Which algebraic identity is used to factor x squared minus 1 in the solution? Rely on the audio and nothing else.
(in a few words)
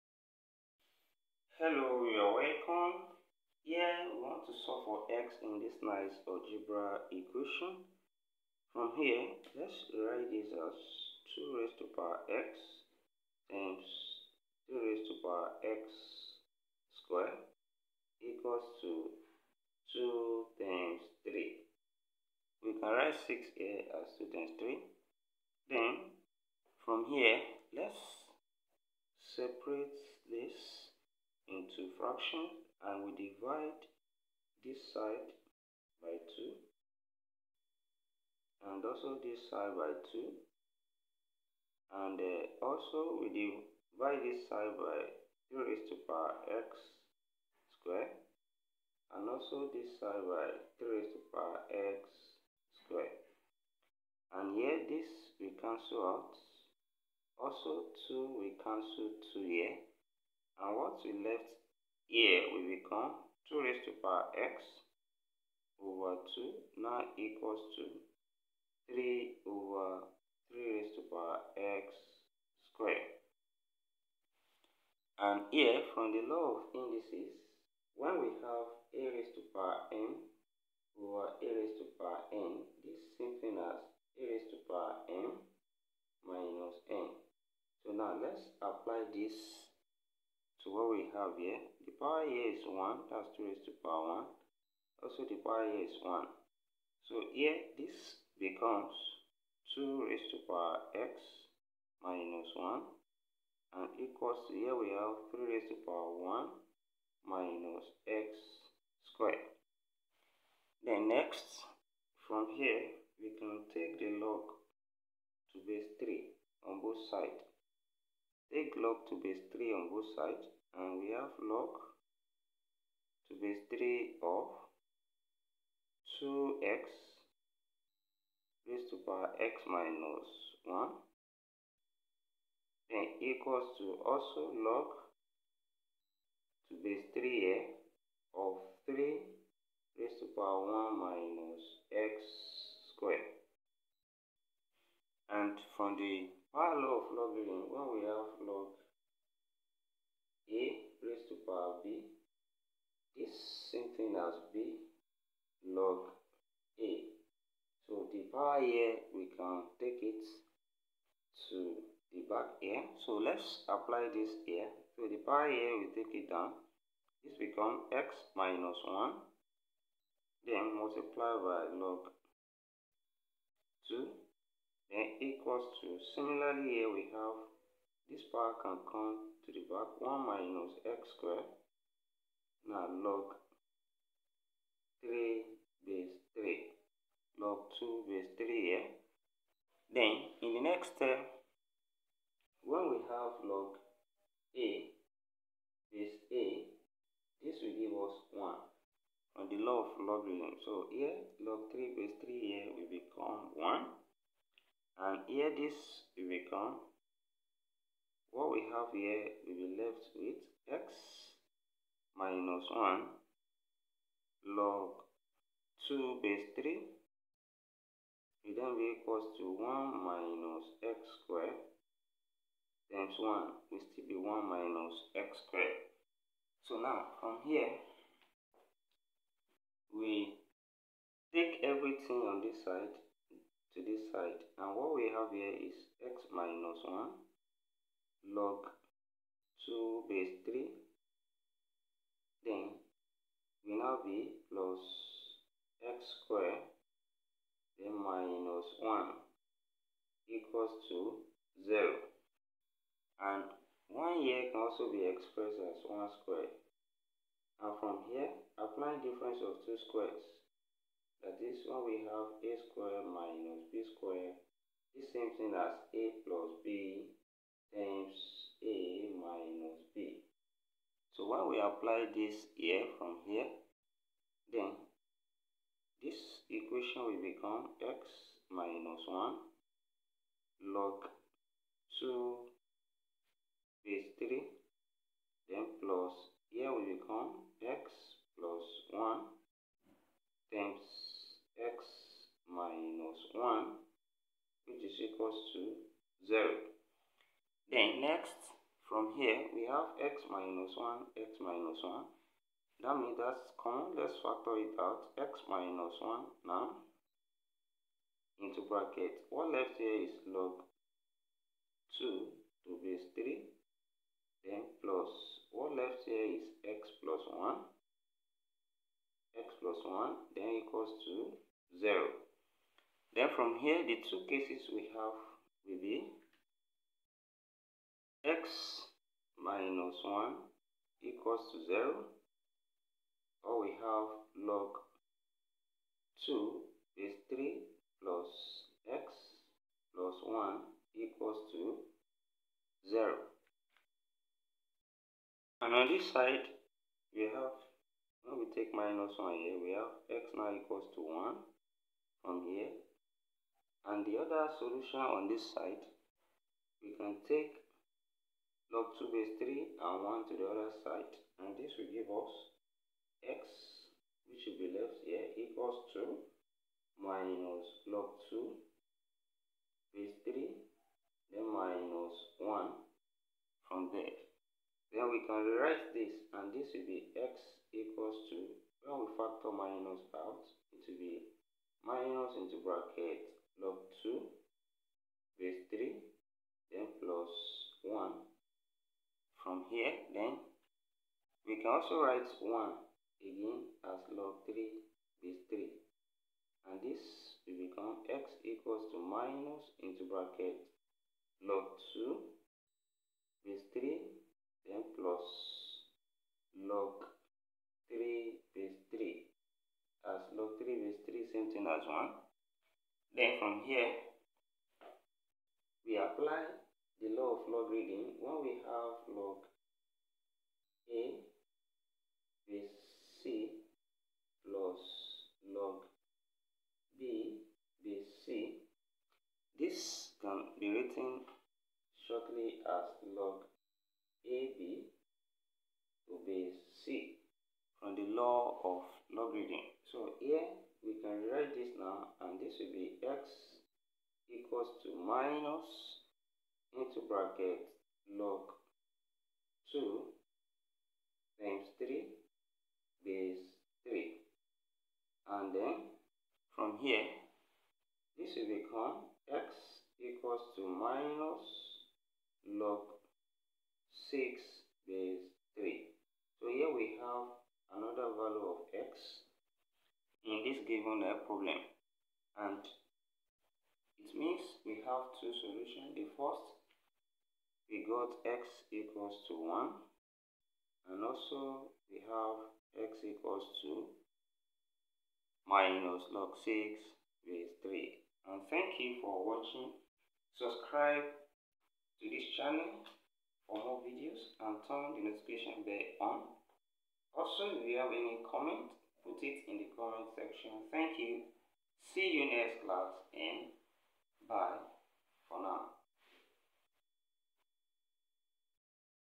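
difference of two squares.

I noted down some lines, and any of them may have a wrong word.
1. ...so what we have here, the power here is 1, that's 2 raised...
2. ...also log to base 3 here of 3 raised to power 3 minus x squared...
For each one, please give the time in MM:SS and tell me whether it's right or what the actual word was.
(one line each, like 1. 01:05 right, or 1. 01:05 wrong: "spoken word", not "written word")
1. 01:30 right
2. 02:14 wrong: "1", not "3".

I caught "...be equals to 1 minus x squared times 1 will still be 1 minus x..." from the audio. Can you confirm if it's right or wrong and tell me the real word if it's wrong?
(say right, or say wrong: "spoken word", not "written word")
right.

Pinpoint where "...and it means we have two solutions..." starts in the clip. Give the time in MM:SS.
07:52.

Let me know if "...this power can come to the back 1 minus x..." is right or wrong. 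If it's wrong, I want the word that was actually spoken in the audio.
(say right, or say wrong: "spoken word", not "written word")
right.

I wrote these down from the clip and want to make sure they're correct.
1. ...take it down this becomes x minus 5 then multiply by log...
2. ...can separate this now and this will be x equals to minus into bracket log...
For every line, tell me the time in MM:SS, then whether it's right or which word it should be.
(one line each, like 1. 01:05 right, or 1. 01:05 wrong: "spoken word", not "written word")
1. 02:45 wrong: "1", not "5"
2. 07:21 wrong: "write", not "separate".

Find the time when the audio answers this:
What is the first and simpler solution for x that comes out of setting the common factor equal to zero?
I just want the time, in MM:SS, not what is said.
05:50.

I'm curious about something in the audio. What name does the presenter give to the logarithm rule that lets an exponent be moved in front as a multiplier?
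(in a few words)
power law.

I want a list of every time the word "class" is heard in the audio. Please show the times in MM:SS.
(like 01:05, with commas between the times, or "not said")
08:22.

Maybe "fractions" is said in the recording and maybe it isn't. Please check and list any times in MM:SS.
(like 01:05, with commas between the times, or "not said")
00:31.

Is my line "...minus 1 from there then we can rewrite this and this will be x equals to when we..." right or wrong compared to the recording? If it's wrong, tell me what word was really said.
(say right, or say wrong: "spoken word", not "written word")
right.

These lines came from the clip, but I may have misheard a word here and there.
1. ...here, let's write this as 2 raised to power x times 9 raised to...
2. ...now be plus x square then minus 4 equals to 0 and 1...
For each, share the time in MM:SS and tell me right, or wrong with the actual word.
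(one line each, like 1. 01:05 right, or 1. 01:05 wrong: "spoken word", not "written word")
1. 00:08 wrong: "2", not "9"
2. 04:03 wrong: "1", not "4".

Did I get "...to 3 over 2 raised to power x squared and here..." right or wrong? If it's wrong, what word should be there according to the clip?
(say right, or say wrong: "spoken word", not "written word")
wrong: "3", not "2".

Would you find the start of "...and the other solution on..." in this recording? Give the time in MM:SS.
05:53.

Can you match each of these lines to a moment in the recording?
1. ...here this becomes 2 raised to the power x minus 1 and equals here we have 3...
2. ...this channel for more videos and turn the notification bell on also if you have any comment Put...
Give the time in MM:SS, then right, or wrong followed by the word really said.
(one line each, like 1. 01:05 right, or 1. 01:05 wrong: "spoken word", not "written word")
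1. 01:37 right
2. 08:12 right.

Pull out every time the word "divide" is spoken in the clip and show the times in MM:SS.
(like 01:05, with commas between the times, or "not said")
00:33, 00:43.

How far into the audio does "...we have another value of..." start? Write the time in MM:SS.
07:46.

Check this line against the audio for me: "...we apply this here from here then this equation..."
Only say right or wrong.
right.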